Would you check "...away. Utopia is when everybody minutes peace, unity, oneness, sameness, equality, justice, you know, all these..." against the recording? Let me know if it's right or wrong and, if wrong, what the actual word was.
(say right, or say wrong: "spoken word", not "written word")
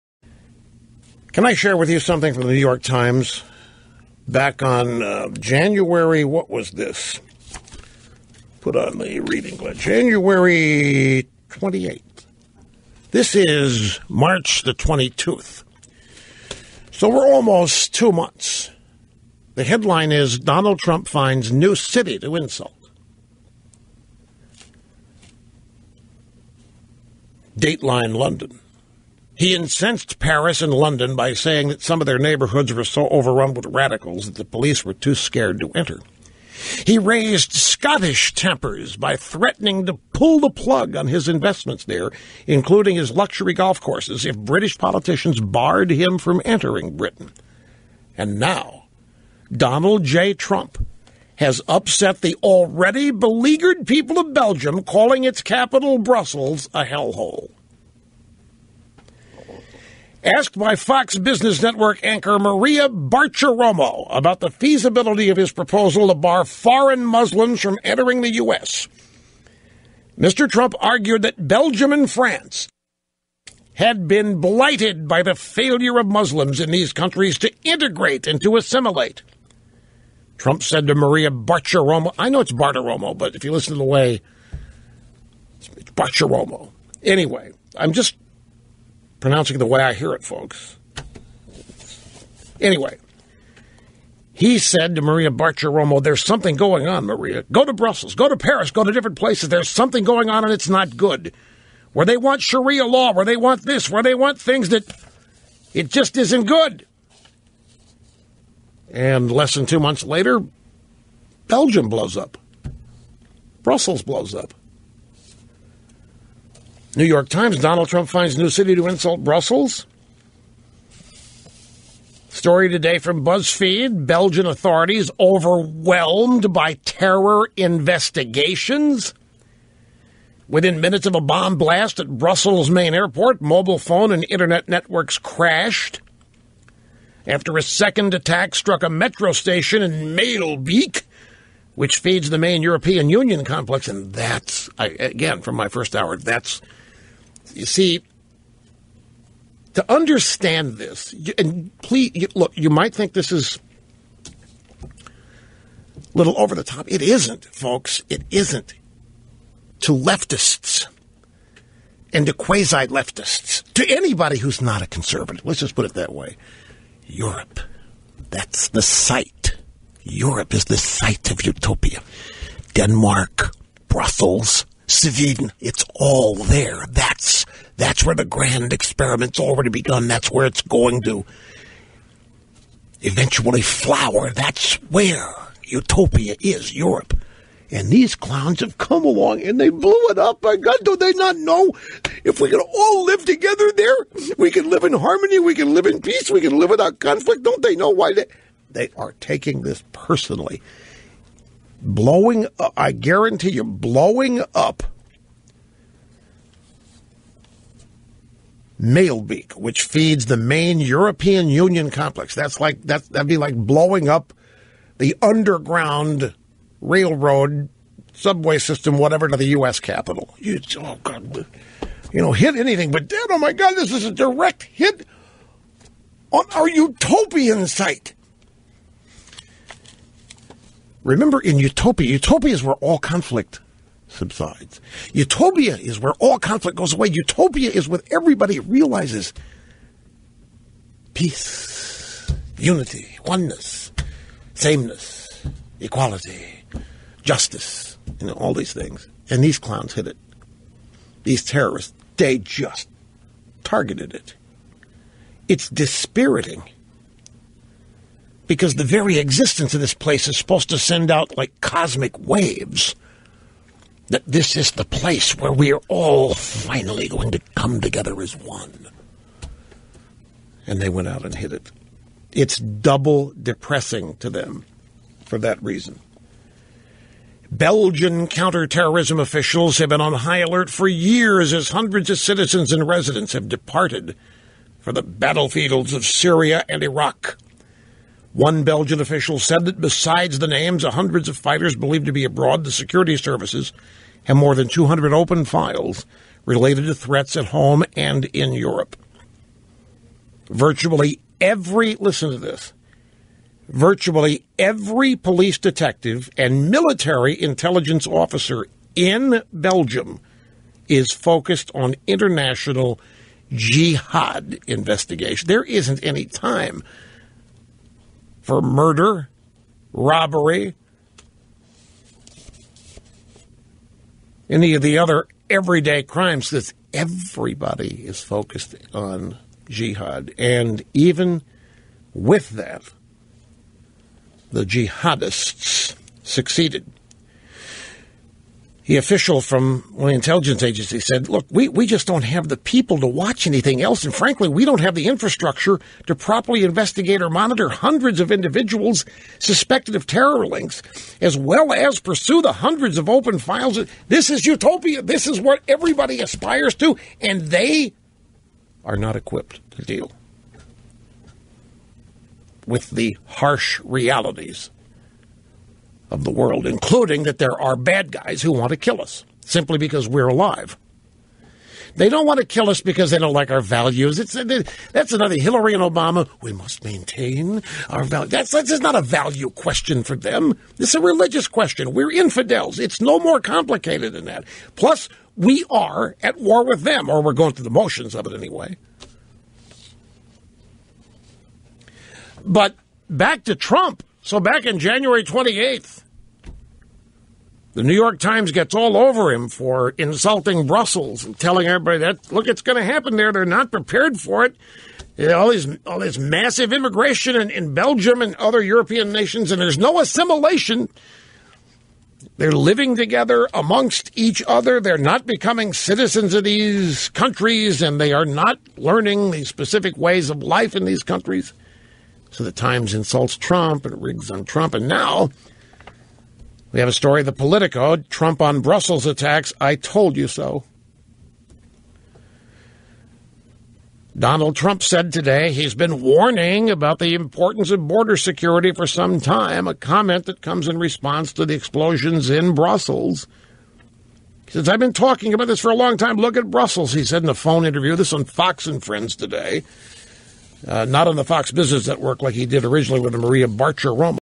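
wrong: "realizes", not "minutes".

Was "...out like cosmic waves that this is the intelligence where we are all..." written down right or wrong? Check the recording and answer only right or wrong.
wrong.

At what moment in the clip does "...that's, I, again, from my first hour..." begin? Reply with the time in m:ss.
2:24.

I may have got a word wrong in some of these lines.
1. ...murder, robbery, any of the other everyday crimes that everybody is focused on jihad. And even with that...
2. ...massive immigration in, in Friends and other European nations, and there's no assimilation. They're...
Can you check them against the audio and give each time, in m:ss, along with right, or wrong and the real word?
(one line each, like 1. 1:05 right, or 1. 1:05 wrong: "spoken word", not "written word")
1. 5:18 right
2. 6:46 wrong: "Belgium", not "Friends".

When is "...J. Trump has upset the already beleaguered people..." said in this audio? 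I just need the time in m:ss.
0:50.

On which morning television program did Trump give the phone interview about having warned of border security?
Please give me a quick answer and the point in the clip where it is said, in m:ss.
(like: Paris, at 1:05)
Fox and Friends, at 7:28.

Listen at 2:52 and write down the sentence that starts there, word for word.
Denmark, Brussels, Sweden, it's all there.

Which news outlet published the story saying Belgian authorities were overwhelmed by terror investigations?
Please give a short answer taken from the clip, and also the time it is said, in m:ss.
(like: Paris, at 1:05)
BuzzFeed, at 2:03.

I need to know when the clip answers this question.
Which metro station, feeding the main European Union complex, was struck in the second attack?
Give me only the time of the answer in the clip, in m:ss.
2:20.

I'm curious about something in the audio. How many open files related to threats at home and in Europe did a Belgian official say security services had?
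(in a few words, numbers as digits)
more than 200.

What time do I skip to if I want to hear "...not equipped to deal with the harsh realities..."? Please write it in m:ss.
5:58.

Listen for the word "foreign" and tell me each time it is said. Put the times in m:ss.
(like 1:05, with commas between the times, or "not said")
1:06.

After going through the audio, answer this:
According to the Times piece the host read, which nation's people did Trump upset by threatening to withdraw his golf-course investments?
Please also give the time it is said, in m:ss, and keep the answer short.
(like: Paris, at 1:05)
Scottish, at 0:37.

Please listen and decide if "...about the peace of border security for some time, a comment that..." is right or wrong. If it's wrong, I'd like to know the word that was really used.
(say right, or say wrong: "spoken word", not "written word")
wrong: "importance", not "peace".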